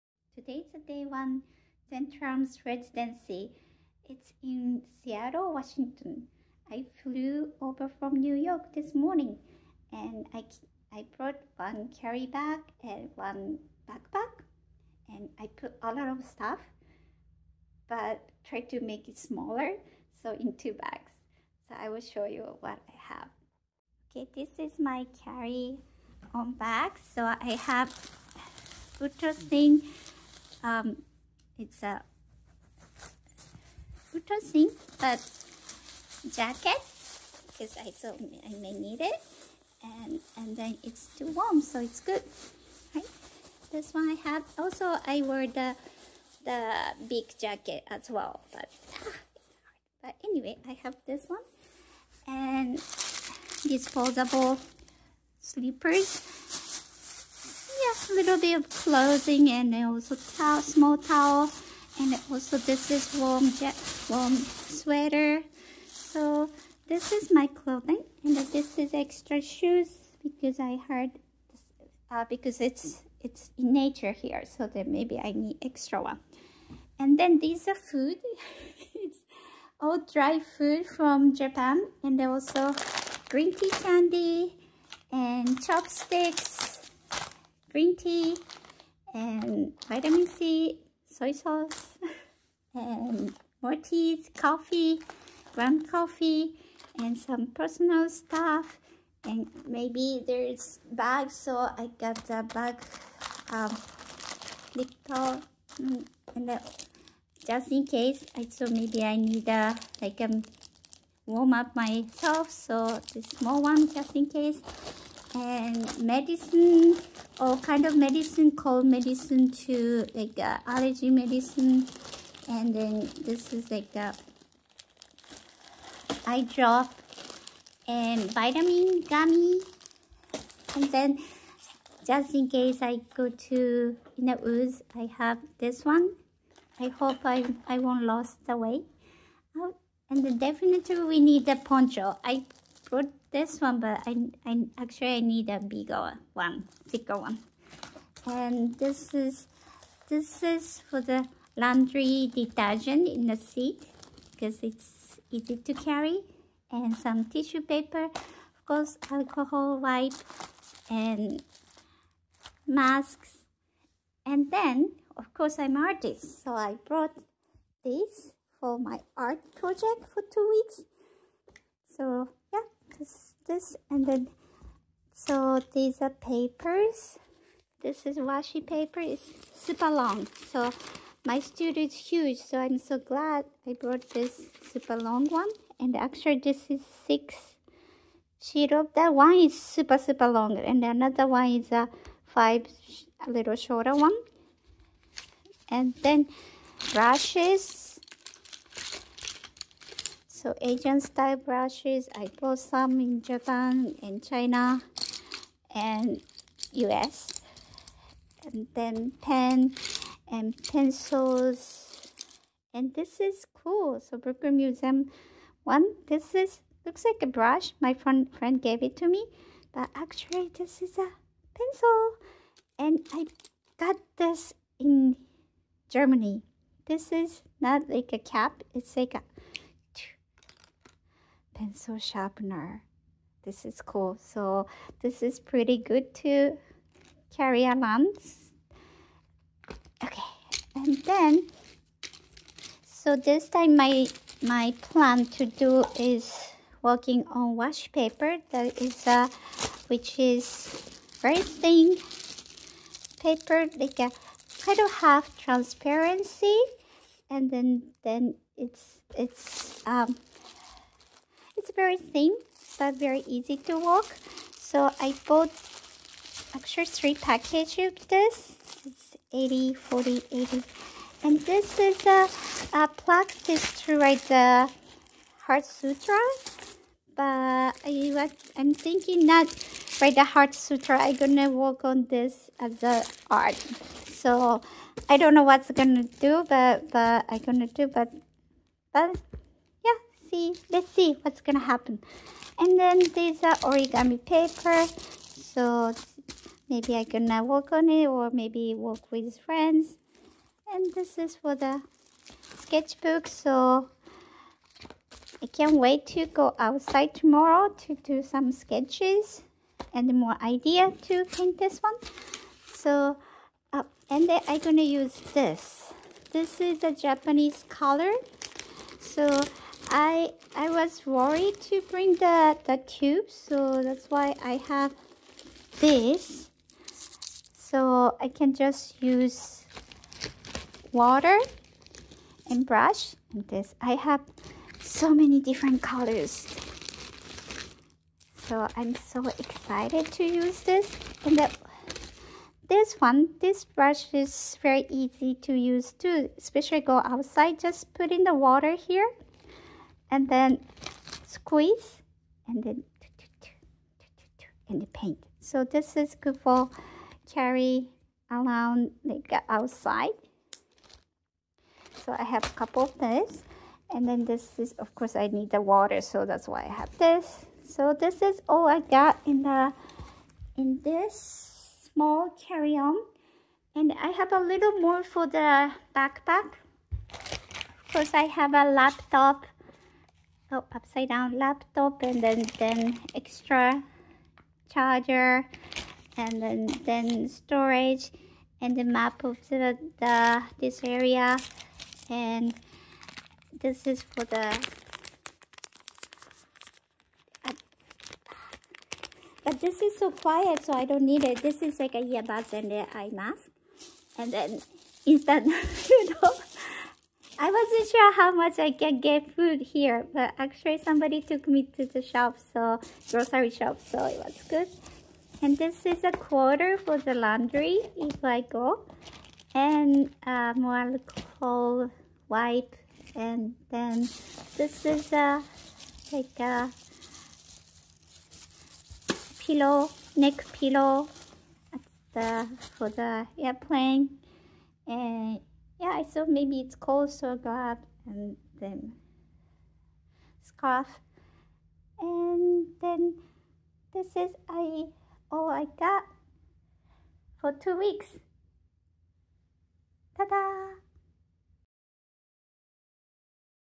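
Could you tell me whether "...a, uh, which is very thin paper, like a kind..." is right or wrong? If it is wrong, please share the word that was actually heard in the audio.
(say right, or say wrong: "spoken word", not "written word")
right.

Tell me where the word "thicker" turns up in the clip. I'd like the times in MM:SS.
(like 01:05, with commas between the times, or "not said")
02:26.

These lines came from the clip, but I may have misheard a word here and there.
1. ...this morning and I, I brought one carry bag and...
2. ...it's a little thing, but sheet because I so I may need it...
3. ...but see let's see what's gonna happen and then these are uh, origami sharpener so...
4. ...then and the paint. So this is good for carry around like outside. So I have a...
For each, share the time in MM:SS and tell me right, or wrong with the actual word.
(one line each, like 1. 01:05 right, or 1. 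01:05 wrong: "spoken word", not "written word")
1. 00:08 right
2. 00:31 wrong: "jacket", not "sheet"
3. 04:48 wrong: "paper", not "sharpener"
4. 05:52 right.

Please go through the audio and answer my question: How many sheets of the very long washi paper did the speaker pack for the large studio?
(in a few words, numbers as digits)
6.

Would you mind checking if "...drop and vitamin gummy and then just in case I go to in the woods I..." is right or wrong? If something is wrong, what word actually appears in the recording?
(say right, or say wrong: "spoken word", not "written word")
right.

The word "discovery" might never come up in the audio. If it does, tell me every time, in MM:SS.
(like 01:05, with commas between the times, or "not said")
not said.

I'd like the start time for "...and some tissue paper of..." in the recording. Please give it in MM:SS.
02:36.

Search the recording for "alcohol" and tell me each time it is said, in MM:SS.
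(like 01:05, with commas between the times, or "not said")
02:39, 07:00.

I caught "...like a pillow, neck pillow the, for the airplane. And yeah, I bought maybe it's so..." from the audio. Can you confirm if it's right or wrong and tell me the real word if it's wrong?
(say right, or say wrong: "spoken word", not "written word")
wrong: "thought", not "bought".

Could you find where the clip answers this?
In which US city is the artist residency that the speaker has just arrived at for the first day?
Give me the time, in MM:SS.
00:05.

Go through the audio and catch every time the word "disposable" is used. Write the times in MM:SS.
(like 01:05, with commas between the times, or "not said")
00:53.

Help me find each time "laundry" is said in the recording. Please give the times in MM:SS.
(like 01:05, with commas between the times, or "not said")
02:31, 06:57.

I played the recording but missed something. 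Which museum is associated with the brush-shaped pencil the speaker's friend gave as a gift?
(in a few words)
Brooklyn Museum.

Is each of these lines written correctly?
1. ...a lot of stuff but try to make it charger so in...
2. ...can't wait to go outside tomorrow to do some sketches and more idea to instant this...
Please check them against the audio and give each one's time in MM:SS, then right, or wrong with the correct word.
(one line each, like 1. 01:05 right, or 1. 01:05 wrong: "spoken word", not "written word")
1. 00:15 wrong: "smaller", not "charger"
2. 05:05 wrong: "paint", not "instant".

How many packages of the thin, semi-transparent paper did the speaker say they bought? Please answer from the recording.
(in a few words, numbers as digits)
3.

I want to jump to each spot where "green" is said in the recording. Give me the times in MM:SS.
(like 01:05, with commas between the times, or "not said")
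01:23, 01:27.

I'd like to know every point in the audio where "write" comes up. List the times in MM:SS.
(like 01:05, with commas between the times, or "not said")
04:33, 04:40.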